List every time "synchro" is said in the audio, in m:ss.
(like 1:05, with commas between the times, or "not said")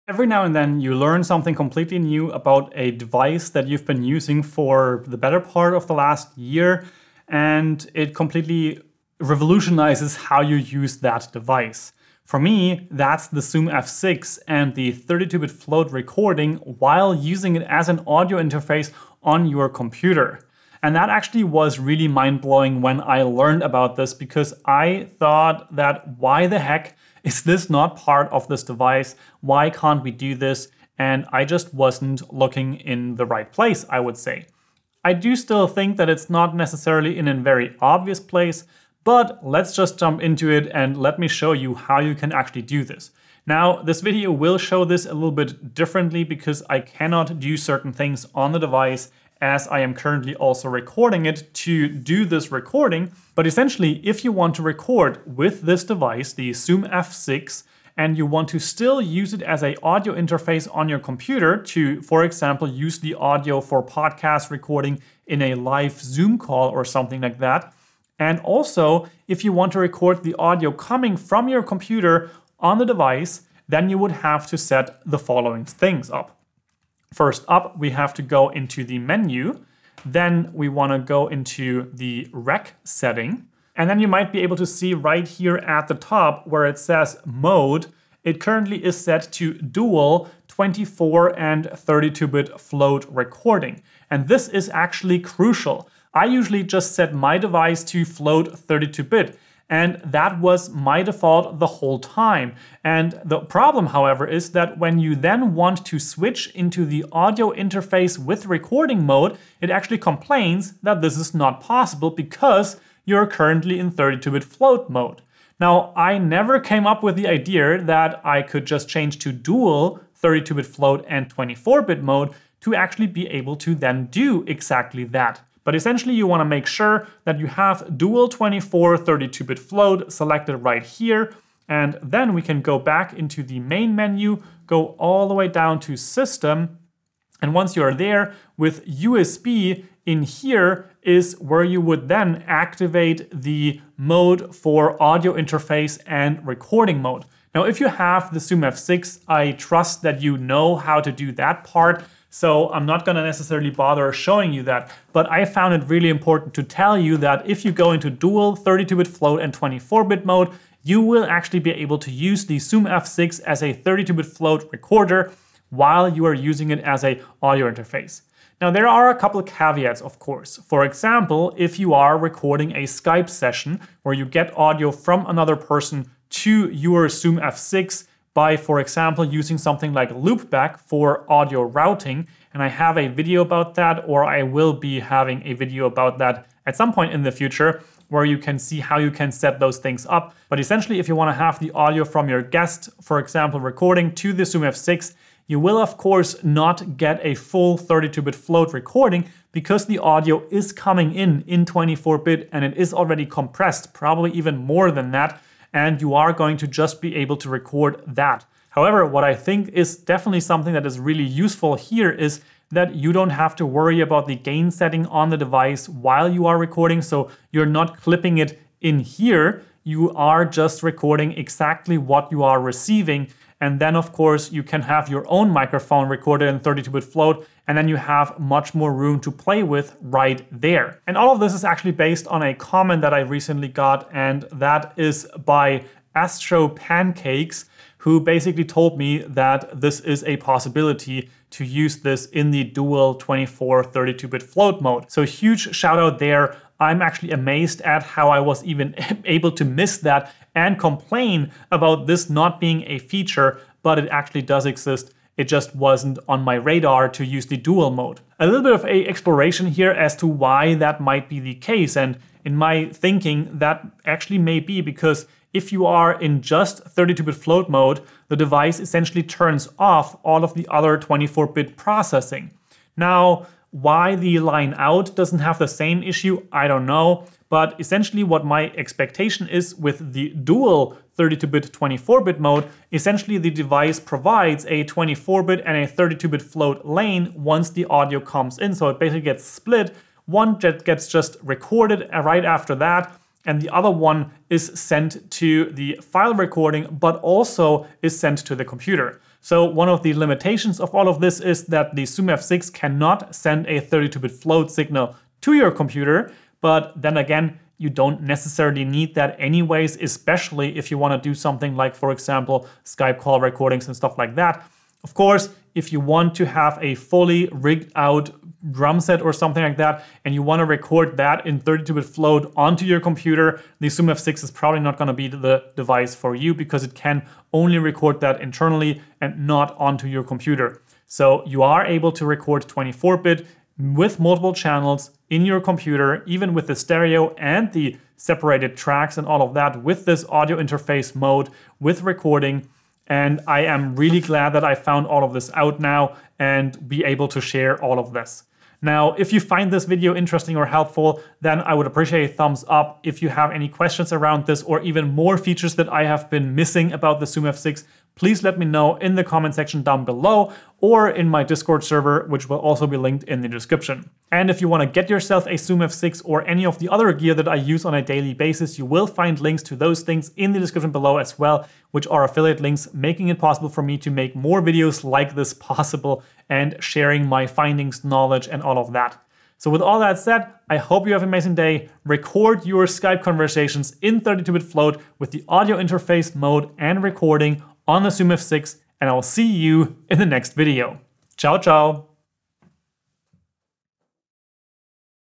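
not said.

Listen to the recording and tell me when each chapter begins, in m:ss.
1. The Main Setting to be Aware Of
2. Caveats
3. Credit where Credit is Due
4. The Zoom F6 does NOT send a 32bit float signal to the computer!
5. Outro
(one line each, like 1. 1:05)
1. 0:53
2. 2:48
3. 3:51
4. 4:59
5. 5:48.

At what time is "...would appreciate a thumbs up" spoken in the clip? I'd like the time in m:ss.
5:51.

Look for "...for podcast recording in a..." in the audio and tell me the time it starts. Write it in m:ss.
1:03.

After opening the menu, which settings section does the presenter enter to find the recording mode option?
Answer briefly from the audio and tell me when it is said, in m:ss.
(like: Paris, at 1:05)
rec setting, at 1:22.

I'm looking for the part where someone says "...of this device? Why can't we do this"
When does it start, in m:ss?
0:28.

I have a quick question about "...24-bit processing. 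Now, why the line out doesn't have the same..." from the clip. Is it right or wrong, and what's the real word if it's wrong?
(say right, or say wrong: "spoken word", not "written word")
right.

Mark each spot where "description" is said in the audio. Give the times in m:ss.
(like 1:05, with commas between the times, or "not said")
6:03, 6:10.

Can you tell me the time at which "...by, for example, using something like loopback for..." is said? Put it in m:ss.
2:58.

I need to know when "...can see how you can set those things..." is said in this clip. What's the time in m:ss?
3:08.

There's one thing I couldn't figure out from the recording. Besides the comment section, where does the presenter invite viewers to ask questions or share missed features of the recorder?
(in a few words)
Discord server.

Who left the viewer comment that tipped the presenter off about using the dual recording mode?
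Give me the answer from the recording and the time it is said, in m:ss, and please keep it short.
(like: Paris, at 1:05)
Astro Pancakes, at 3:56.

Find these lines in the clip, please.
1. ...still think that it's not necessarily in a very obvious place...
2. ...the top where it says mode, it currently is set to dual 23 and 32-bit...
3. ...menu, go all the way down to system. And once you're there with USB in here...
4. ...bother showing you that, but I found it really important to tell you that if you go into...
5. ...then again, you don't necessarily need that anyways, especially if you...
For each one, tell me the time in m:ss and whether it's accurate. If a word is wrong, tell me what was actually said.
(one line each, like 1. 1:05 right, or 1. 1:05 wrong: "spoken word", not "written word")
1. 0:35 right
2. 1:25 wrong: "24", not "23"
3. 2:13 right
4. 2:33 right
5. 5:07 right.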